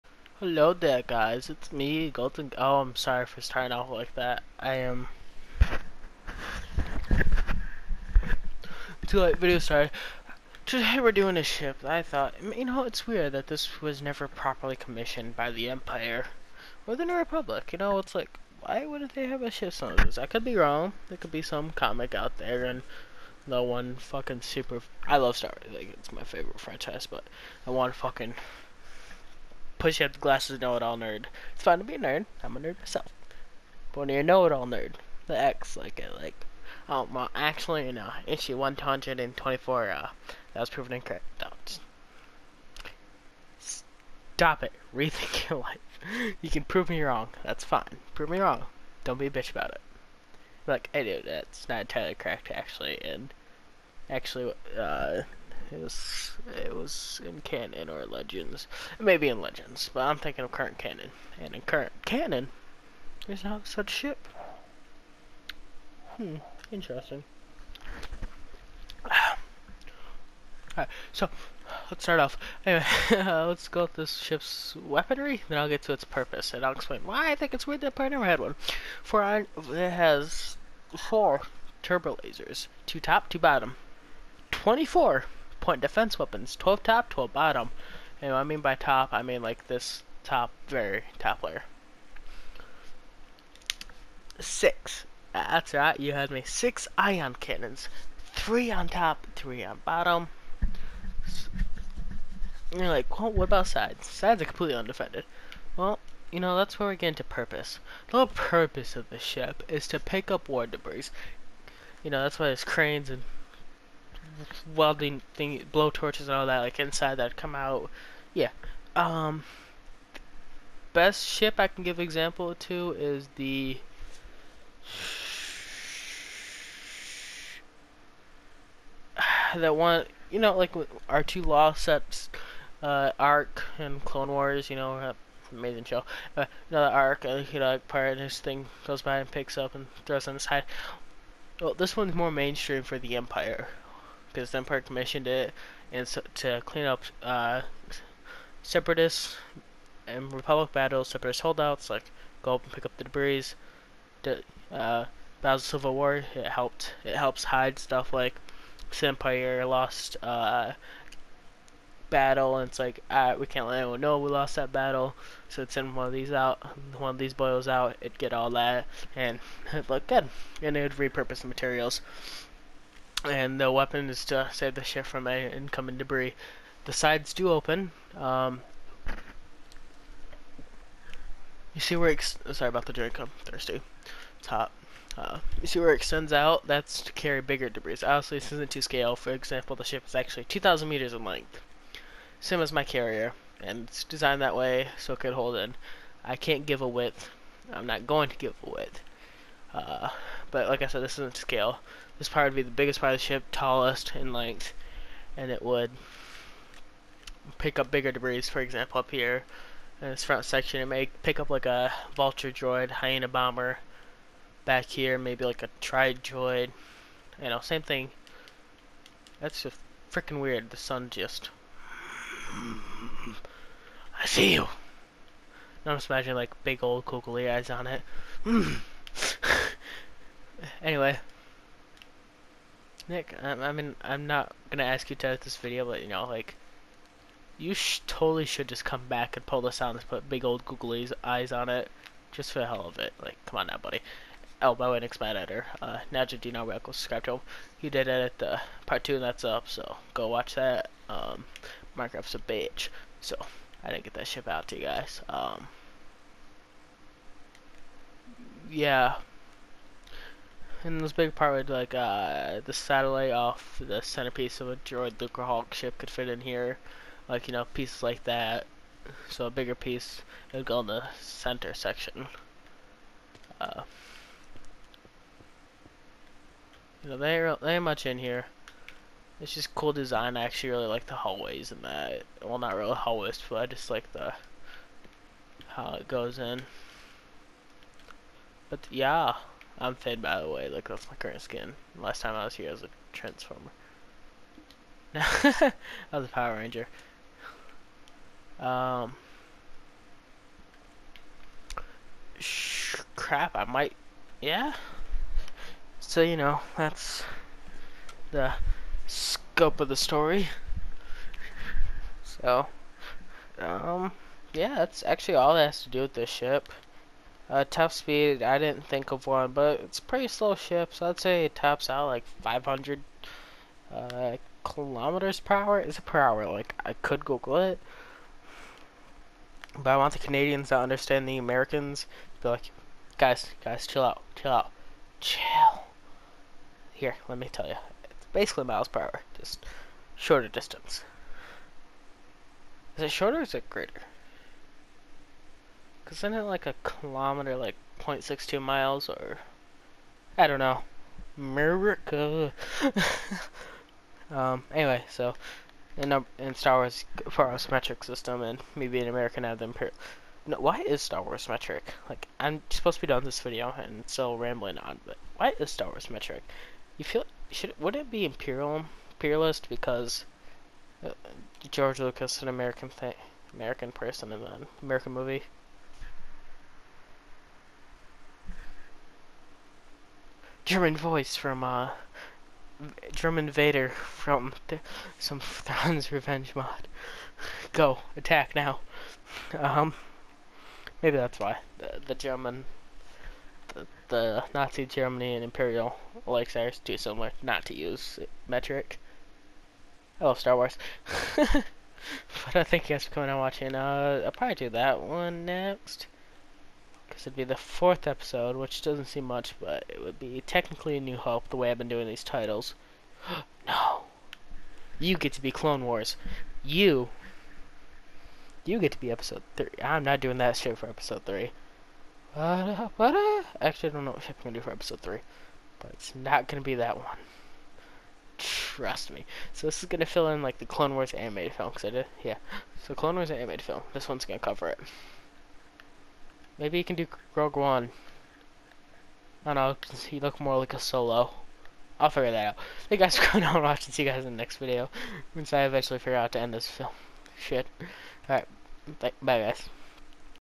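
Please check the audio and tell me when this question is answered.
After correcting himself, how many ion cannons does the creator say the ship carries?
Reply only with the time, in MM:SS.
01:36.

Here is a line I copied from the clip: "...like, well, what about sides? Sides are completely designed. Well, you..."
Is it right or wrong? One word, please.
wrong.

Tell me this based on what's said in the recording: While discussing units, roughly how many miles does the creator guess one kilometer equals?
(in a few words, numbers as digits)
0.62.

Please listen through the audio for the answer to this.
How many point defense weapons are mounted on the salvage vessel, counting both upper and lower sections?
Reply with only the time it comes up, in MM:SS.
01:24.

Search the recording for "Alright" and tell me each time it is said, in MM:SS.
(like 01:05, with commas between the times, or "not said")
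01:09, 07:28.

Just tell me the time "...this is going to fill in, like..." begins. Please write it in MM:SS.
07:09.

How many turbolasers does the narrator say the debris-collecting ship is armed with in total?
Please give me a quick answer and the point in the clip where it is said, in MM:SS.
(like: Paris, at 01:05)
4, at 01:21.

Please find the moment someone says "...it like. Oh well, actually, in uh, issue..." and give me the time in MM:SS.
00:35.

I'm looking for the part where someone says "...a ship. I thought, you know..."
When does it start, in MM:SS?
00:11.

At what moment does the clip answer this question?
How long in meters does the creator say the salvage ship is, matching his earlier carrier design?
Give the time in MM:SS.
03:10.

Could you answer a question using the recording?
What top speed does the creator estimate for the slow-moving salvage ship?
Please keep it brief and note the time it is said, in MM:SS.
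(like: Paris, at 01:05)
500 kilometers per hour, at 05:22.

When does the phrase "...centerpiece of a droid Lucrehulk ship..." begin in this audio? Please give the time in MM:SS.
04:24.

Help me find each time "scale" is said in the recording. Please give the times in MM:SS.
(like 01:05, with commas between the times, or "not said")
03:08, 03:21.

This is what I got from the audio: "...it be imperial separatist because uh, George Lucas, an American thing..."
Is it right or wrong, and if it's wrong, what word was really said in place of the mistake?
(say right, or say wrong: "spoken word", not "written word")
wrong: "imperialist", not "separatist".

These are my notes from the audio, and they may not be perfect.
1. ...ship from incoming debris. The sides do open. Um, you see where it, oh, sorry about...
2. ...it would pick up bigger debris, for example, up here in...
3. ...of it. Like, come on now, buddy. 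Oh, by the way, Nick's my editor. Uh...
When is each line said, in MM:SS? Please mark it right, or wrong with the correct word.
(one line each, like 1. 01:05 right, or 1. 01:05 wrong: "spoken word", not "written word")
1. 02:54 right
2. 03:25 right
3. 04:02 right.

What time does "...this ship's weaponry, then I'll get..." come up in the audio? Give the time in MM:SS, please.
01:13.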